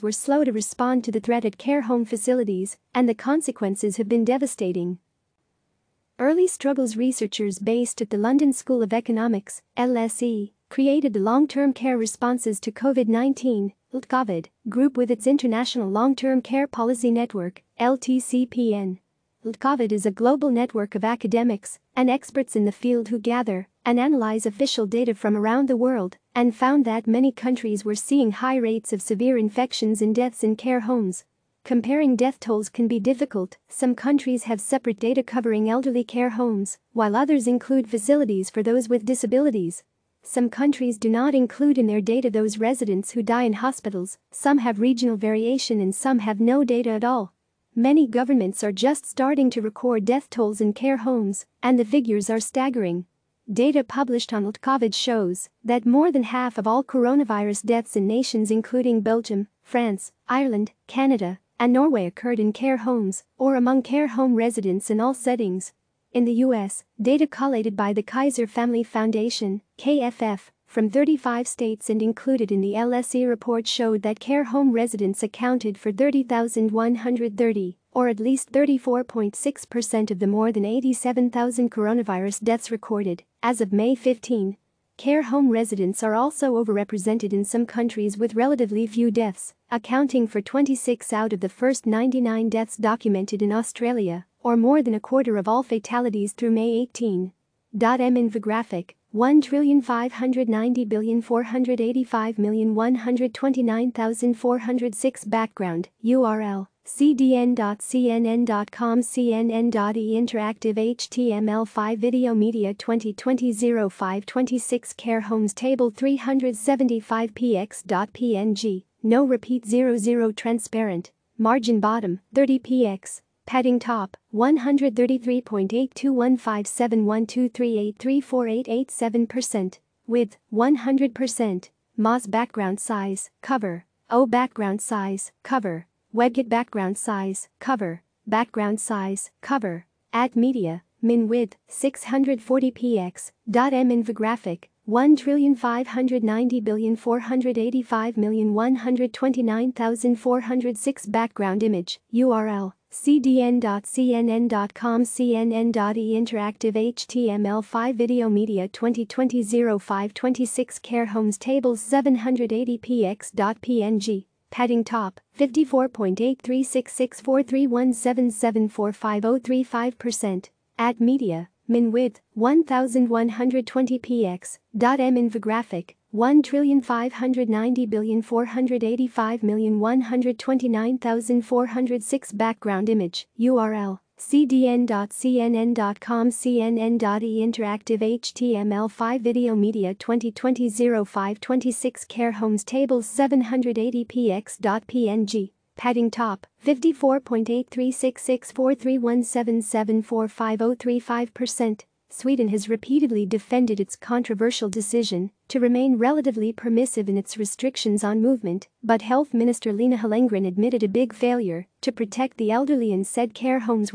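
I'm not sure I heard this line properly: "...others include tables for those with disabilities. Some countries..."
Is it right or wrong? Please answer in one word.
wrong.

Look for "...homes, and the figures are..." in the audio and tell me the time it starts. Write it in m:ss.
0:50.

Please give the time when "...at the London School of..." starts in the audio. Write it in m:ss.
0:08.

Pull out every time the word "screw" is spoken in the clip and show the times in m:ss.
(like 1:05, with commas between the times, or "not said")
not said.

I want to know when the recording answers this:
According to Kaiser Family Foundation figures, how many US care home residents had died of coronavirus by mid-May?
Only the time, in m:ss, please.
1:15.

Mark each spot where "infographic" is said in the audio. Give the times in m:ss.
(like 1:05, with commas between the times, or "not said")
1:37, 2:23, 2:55.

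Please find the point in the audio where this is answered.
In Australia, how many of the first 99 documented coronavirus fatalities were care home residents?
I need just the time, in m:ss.
1:30.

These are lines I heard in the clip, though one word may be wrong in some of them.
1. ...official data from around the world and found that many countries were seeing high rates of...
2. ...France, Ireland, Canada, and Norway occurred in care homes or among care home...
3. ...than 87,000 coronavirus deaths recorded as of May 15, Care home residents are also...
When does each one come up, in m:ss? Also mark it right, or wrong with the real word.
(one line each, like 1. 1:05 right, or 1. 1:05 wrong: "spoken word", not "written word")
1. 0:24 right
2. 0:59 right
3. 1:20 right.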